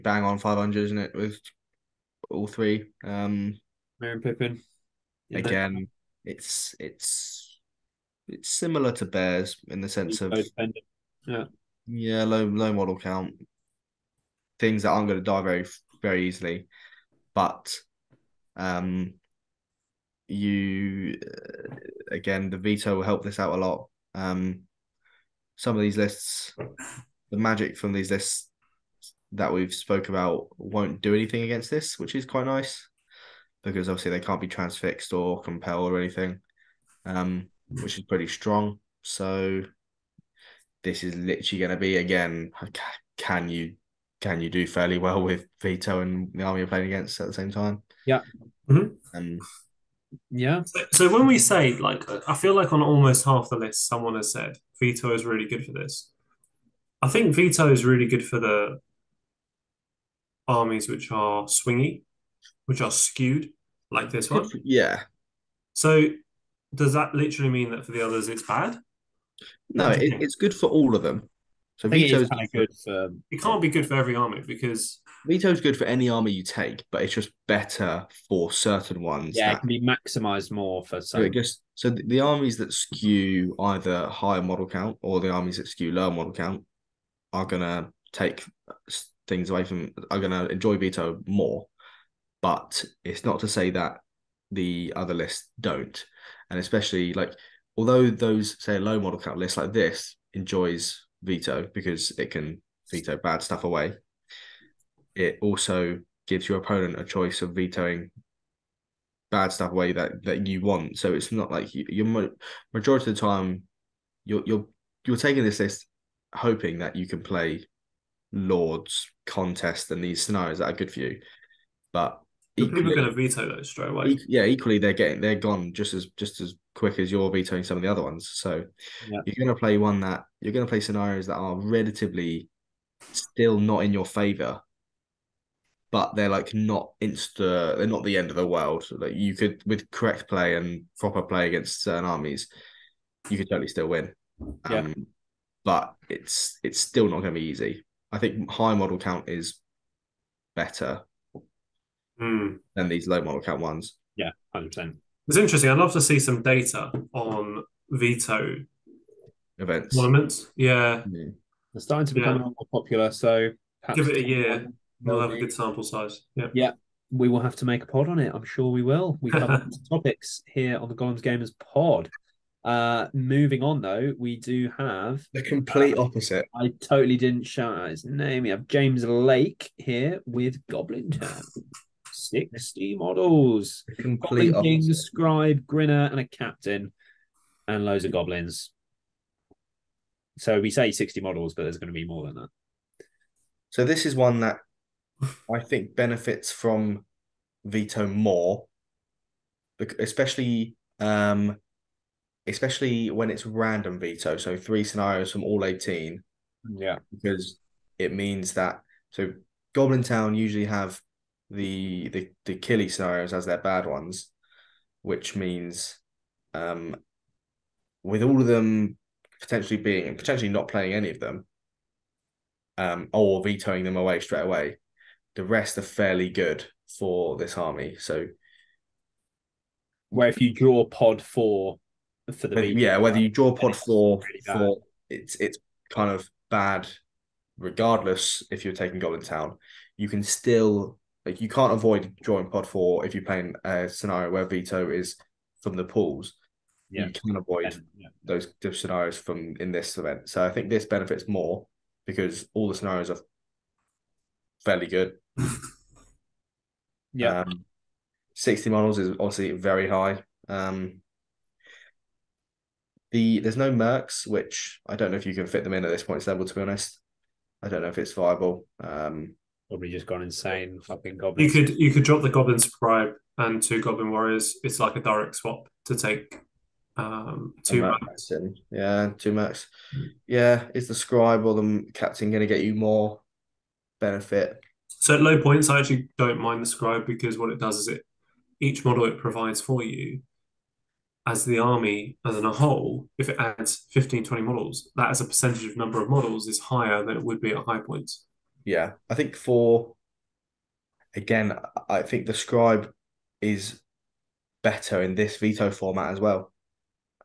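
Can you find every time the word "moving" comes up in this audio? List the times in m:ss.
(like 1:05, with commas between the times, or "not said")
2:53.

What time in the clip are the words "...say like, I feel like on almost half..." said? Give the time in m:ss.
0:51.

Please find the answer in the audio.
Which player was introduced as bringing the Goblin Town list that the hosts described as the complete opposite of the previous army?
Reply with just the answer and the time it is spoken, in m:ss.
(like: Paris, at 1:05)
James Lake, at 2:58.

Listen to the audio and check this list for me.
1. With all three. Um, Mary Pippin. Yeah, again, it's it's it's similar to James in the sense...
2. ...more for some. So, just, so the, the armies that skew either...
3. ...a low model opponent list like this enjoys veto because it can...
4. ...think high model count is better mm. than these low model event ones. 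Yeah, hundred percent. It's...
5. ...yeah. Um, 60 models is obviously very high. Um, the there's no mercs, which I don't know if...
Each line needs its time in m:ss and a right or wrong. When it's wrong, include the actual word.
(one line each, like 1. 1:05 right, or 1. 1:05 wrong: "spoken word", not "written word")
1. 0:01 wrong: "Bears", not "James"
2. 1:20 right
3. 1:38 wrong: "count", not "opponent"
4. 2:28 wrong: "count", not "event"
5. 4:17 right.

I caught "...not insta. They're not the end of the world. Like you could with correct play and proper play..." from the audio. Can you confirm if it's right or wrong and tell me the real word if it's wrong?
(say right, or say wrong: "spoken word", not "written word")
right.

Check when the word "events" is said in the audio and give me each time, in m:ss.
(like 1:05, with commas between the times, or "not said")
2:39, 4:09.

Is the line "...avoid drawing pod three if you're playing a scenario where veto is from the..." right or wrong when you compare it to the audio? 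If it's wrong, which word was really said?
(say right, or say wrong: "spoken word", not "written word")
wrong: "four", not "three".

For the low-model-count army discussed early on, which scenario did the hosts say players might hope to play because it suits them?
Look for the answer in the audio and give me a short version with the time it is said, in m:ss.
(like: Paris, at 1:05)
Lords contest, at 1:58.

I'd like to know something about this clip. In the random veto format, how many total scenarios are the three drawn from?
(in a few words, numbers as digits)
18.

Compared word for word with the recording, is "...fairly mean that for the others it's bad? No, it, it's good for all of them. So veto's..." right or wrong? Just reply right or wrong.
wrong.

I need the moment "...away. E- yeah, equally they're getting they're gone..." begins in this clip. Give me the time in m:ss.
2:03.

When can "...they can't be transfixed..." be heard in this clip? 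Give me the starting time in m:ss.
0:34.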